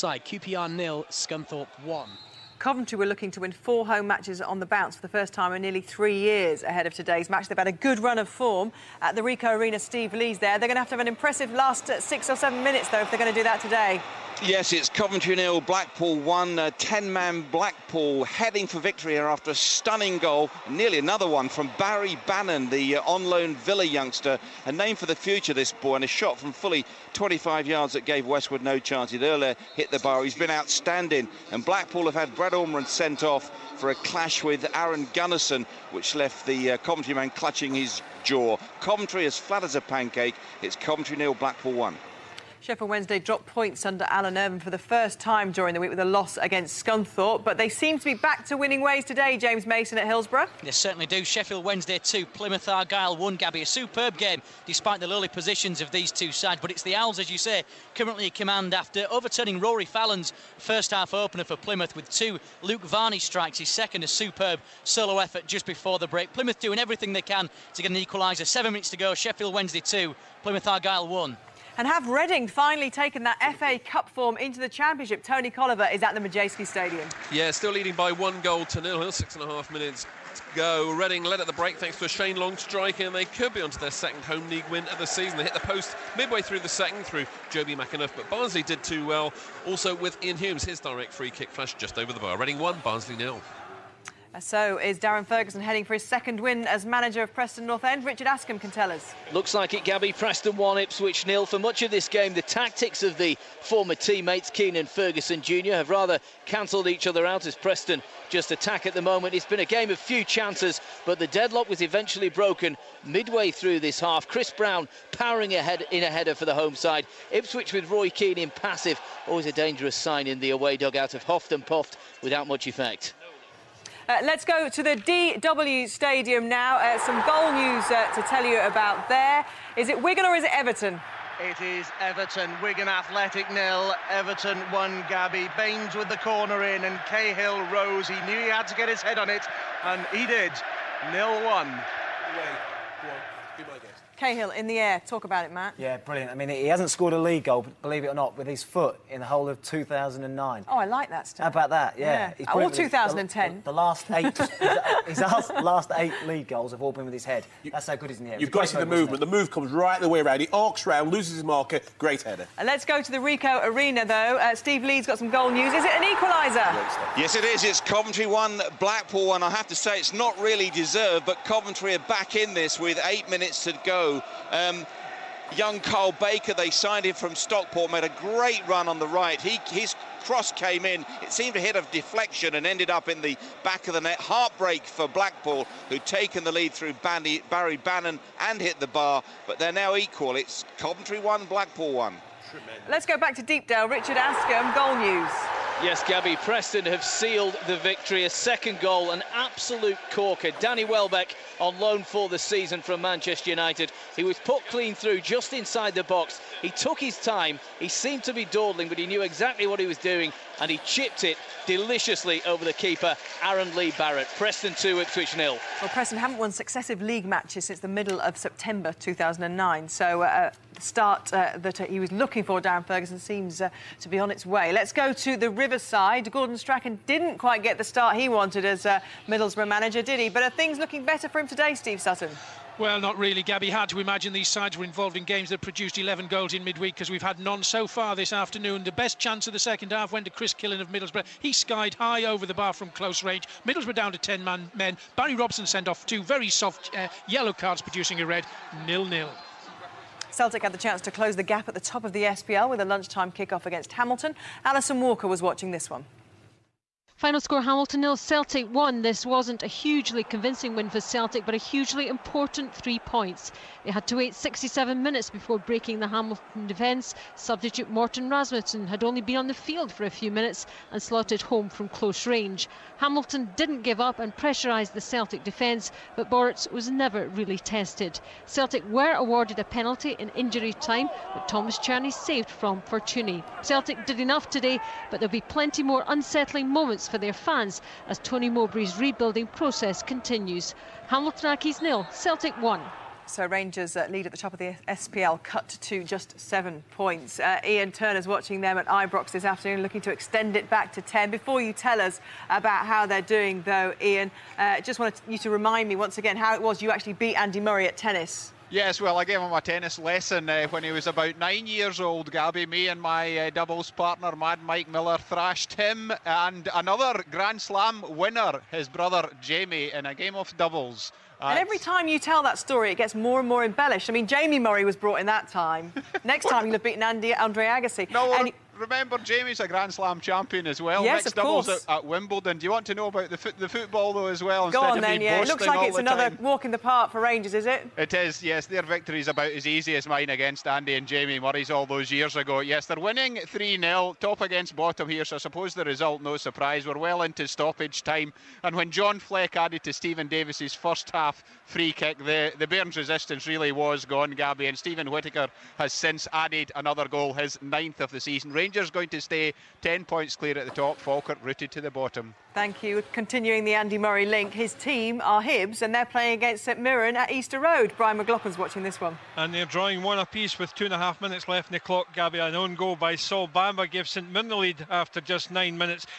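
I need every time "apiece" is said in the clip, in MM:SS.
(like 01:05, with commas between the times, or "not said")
06:10.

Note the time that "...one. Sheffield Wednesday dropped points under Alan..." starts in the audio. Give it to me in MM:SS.
00:41.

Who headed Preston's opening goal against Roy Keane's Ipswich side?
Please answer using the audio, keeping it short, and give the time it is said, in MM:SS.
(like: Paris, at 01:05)
Chris Brown, at 01:54.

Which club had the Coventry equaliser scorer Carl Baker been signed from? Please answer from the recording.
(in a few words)
Stockport.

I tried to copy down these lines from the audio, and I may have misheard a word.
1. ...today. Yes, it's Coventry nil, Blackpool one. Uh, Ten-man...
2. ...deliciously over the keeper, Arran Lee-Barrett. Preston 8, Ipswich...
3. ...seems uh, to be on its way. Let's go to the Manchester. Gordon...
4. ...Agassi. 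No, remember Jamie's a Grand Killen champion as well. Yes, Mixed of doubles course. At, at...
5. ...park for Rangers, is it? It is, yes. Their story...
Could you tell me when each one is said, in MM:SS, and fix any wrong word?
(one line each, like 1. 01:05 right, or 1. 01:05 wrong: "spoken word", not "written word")
1. 00:13 right
2. 03:31 wrong: "2", not "8"
3. 03:43 wrong: "Riverside", not "Manchester"
4. 05:27 wrong: "Slam", not "Killen"
5. 05:36 wrong: "victory", not "story".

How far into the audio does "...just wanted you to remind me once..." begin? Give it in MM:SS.
05:04.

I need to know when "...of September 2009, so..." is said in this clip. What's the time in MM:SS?
03:38.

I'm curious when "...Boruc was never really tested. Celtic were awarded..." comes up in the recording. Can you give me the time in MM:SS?
04:36.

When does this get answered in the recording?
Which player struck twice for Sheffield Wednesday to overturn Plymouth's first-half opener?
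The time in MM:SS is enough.
01:02.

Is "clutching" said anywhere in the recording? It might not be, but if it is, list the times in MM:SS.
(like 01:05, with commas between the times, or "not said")
00:37.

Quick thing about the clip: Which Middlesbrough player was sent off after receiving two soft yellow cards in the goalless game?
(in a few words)
Barry Robson.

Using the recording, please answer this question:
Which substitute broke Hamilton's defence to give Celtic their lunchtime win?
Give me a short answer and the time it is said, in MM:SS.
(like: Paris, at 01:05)
Morten Rasmussen, at 04:27.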